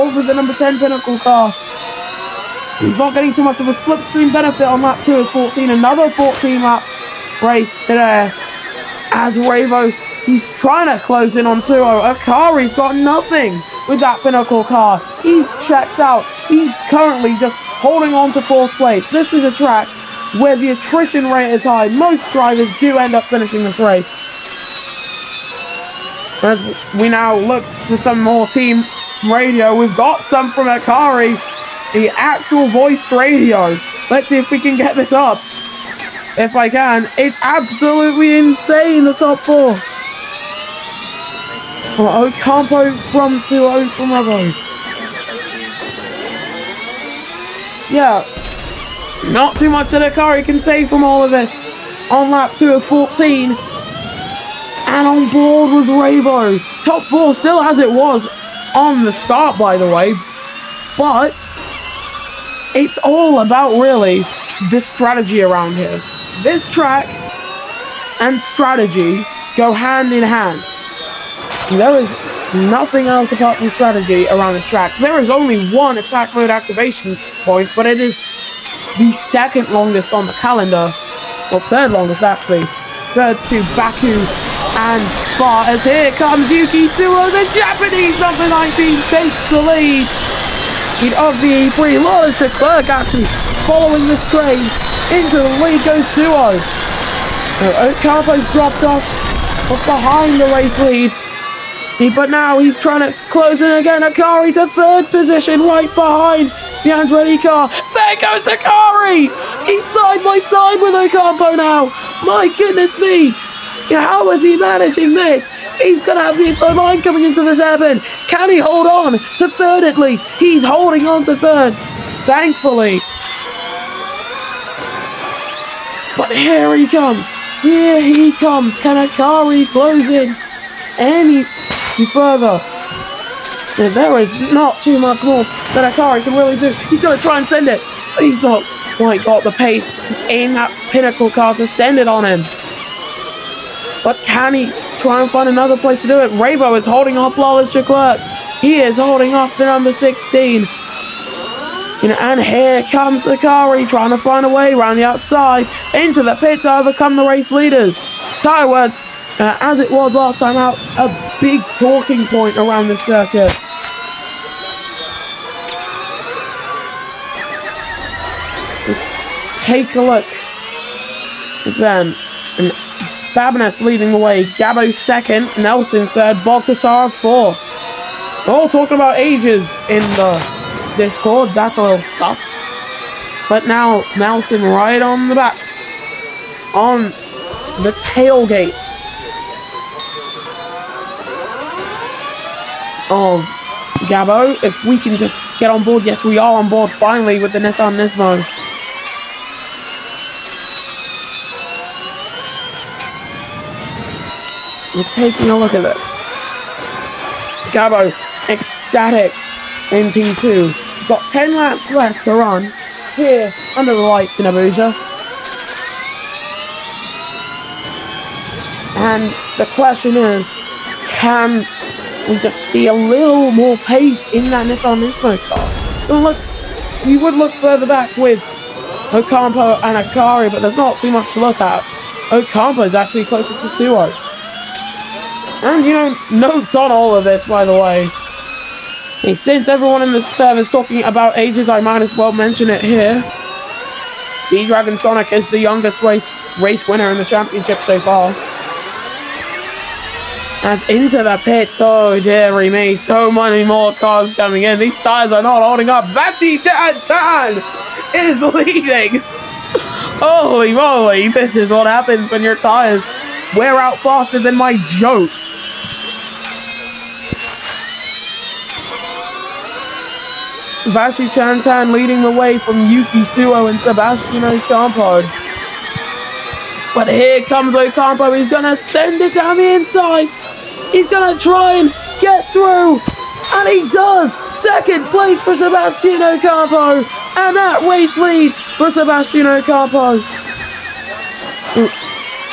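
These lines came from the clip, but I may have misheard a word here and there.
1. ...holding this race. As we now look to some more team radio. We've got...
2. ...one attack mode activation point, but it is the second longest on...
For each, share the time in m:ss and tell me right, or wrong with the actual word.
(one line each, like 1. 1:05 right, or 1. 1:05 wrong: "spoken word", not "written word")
1. 0:23 wrong: "finishing", not "holding"
2. 1:15 right.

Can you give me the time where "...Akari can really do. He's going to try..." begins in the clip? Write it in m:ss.
2:15.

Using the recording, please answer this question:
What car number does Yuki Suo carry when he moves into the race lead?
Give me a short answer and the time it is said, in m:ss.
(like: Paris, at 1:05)
19, at 1:27.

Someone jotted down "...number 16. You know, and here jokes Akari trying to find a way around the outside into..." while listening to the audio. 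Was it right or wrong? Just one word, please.
wrong.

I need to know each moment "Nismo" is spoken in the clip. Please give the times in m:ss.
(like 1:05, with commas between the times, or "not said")
3:17, 3:45.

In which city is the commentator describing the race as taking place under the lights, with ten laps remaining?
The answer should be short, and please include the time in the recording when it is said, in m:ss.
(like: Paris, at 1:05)
Abuja, at 3:33.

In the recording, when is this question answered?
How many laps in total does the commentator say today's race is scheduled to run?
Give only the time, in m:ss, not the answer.
0:05.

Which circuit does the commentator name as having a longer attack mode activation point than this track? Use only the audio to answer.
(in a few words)
Baku.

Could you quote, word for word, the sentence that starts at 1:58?
Can he hold on to third at least?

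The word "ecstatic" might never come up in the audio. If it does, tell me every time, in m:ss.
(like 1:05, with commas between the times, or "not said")
3:28.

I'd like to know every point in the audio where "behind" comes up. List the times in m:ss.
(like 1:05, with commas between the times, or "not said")
1:39, 1:45.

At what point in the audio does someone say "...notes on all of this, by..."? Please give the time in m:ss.
3:56.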